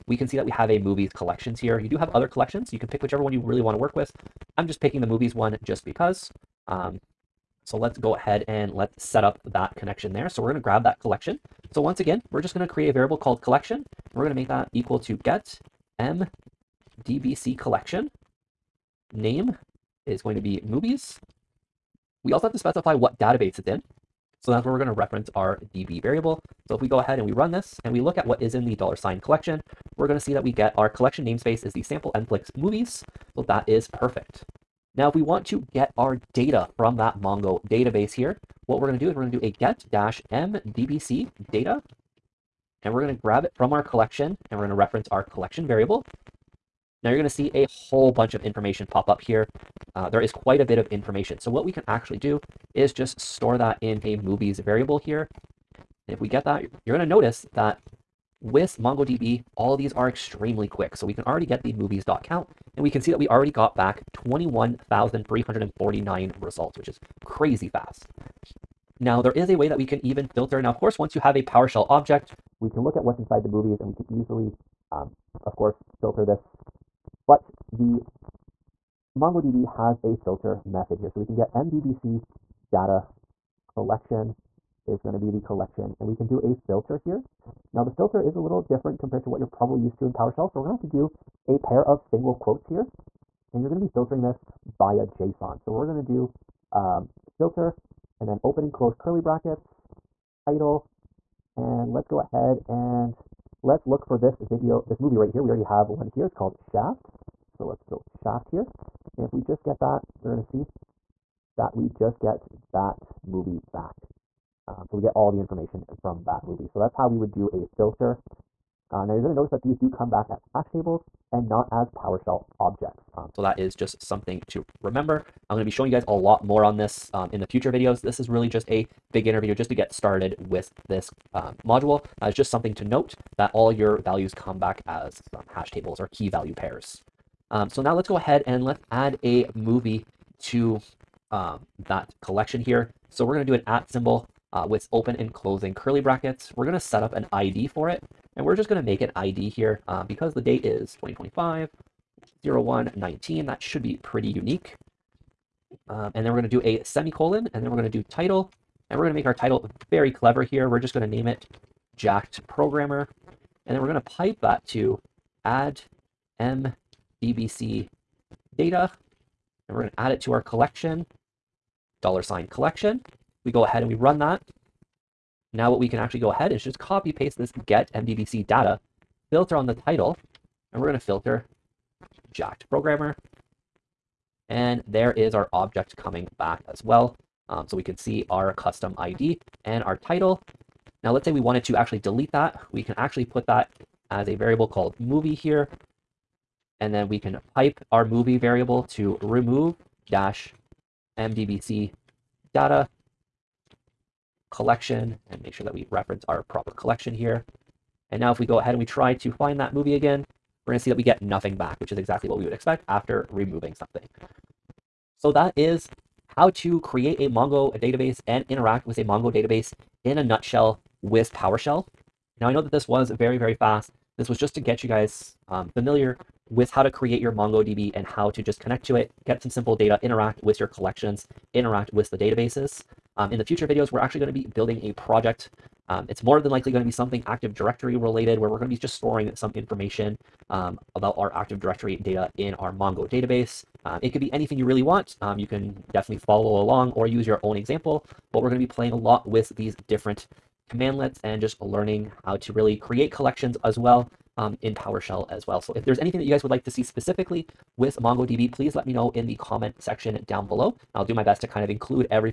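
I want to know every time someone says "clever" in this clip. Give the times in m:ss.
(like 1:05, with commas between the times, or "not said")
2:40.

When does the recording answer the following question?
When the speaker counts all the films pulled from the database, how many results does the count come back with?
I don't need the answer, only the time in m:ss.
1:04.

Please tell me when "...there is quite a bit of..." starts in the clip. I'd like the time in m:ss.
0:50.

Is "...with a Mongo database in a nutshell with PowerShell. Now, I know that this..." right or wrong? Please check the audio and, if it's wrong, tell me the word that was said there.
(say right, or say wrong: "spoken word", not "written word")
right.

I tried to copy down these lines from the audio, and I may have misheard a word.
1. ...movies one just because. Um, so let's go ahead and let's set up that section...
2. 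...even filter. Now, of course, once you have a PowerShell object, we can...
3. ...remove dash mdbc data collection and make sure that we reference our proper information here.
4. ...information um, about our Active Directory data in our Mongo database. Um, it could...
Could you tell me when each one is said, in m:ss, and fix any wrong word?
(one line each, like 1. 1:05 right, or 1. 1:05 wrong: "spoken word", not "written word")
1. 0:05 wrong: "connection", not "section"
2. 1:10 right
3. 3:19 wrong: "collection", not "information"
4. 3:59 right.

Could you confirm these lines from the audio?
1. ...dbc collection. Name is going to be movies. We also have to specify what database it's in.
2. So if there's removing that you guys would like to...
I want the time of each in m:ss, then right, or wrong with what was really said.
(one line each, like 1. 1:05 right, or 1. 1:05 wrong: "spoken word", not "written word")
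1. 0:17 right
2. 4:15 wrong: "anything", not "removing".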